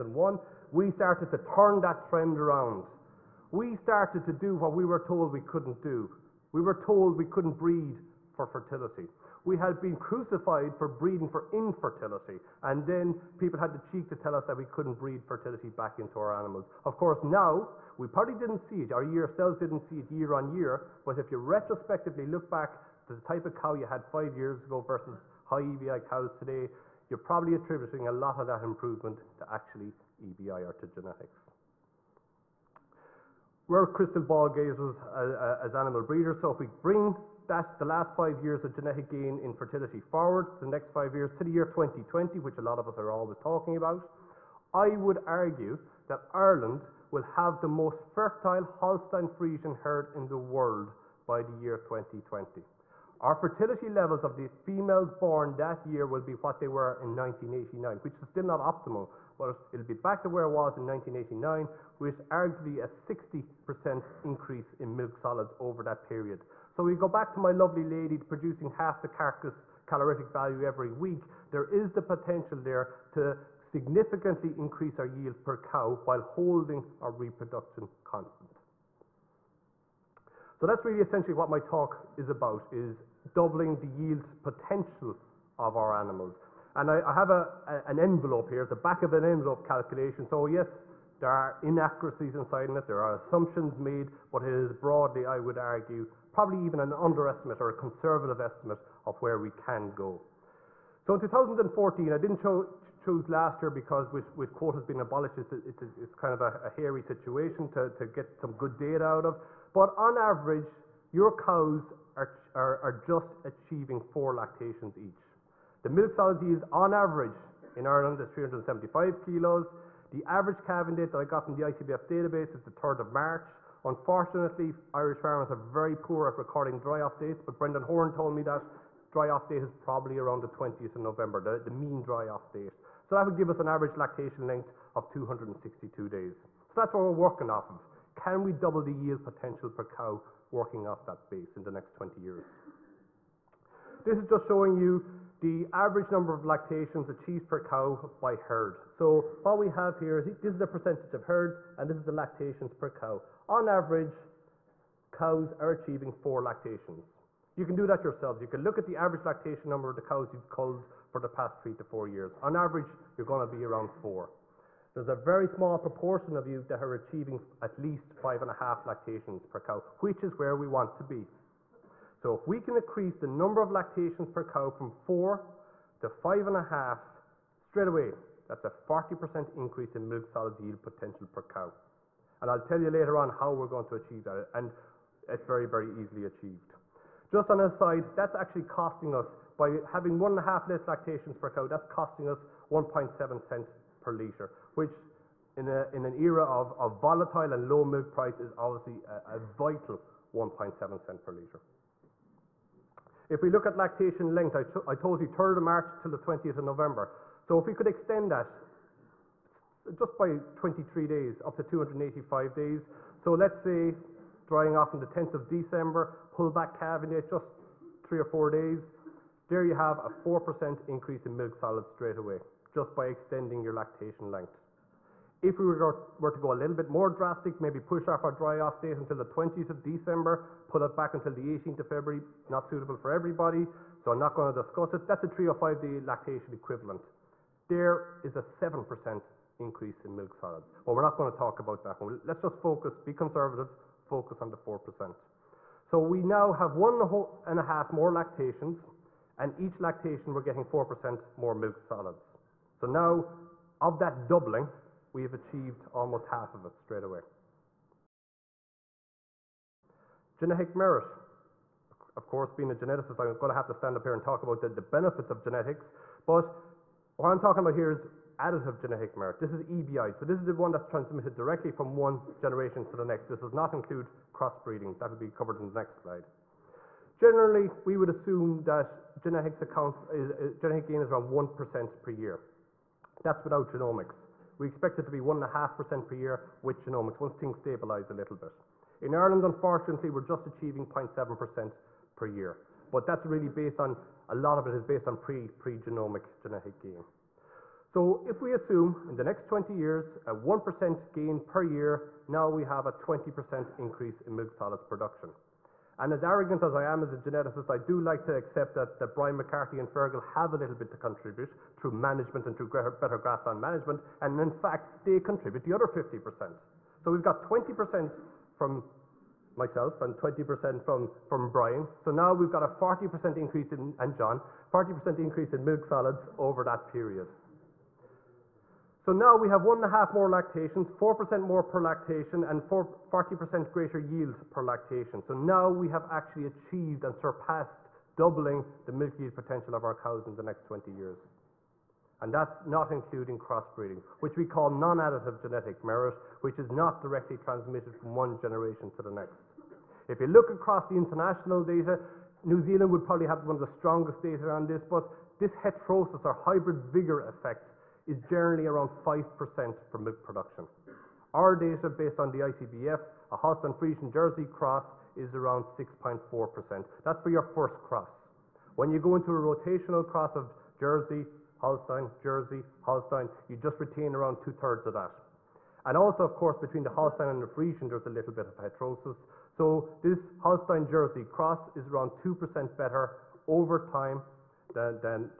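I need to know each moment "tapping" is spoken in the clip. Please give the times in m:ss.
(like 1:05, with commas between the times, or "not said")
not said.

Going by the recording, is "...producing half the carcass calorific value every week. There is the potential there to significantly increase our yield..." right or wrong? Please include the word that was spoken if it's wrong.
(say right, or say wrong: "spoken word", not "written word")
right.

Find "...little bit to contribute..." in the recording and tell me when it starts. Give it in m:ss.
5:10.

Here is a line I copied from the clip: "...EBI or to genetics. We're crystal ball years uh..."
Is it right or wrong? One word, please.
wrong.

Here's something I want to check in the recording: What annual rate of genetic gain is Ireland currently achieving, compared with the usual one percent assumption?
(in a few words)
0.7% per year.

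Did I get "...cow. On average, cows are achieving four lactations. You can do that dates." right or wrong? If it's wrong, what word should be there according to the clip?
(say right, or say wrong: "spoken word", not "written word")
wrong: "yourselves", not "dates".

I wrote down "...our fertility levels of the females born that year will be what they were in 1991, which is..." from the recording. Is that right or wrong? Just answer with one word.
wrong.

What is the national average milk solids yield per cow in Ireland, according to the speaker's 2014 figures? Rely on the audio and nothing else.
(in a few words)
375 kilos.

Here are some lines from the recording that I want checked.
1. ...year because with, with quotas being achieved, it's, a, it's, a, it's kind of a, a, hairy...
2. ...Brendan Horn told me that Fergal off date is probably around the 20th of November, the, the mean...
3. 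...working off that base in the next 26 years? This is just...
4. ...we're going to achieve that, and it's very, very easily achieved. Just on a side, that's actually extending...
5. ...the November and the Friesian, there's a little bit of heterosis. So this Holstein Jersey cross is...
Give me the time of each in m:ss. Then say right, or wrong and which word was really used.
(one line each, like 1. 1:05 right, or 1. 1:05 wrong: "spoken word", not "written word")
1. 1:43 wrong: "abolished", not "achieved"
2. 2:07 wrong: "Dry", not "Fergal"
3. 2:20 wrong: "20", not "26"
4. 3:03 wrong: "costing", not "extending"
5. 6:16 wrong: "Holstein", not "November".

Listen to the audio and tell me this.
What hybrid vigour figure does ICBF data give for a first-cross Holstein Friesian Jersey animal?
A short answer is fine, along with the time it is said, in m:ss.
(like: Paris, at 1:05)
6.4%, at 6:05.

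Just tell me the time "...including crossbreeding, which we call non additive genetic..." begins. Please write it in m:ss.
5:42.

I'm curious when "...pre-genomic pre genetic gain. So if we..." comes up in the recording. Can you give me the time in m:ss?
4:55.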